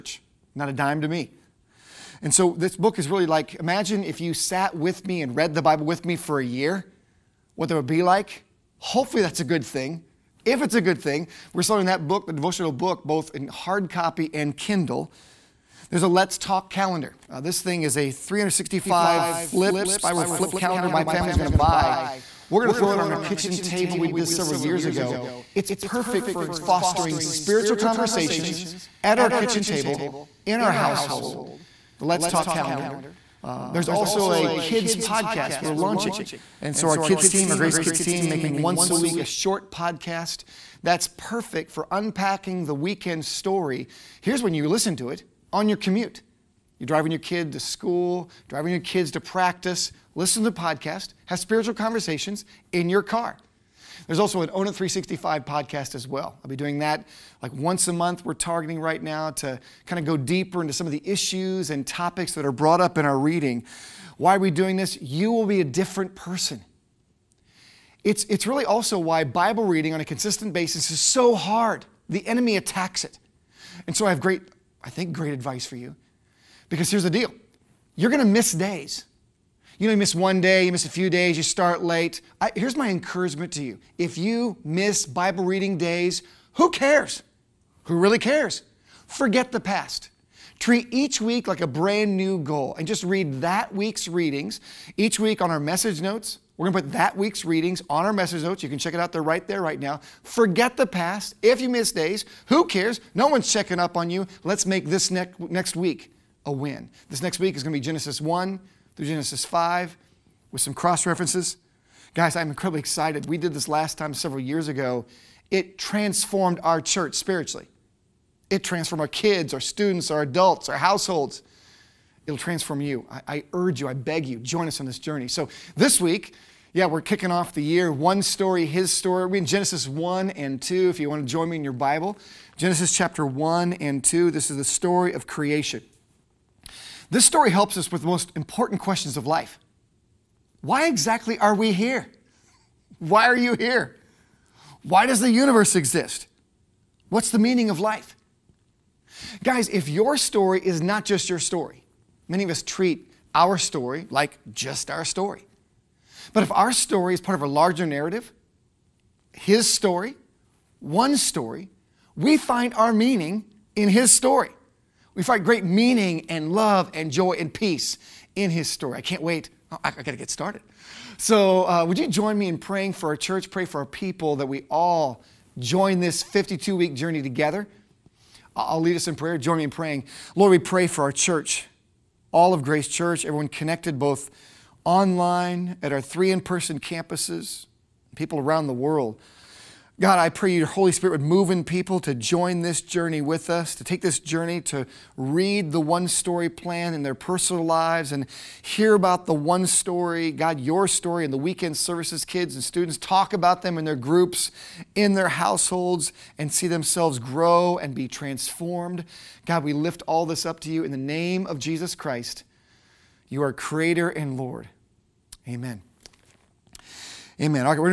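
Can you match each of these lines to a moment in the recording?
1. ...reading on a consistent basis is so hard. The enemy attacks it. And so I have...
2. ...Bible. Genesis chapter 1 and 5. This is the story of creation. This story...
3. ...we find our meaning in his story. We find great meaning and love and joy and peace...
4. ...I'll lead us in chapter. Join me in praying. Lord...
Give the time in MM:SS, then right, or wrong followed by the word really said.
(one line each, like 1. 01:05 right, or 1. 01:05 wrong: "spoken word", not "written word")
1. 01:09 right
2. 02:11 wrong: "2", not "5"
3. 02:42 right
4. 02:58 wrong: "prayer", not "chapter".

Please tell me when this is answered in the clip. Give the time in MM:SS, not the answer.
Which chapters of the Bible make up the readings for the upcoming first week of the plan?
01:47.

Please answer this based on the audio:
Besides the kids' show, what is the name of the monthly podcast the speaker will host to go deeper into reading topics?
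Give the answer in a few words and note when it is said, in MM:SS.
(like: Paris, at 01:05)
Own It 365, at 00:54.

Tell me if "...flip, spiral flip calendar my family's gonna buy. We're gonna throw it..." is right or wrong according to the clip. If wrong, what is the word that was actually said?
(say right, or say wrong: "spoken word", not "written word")
right.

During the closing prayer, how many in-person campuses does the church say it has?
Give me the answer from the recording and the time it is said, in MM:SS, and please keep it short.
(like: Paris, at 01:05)
3, at 03:05.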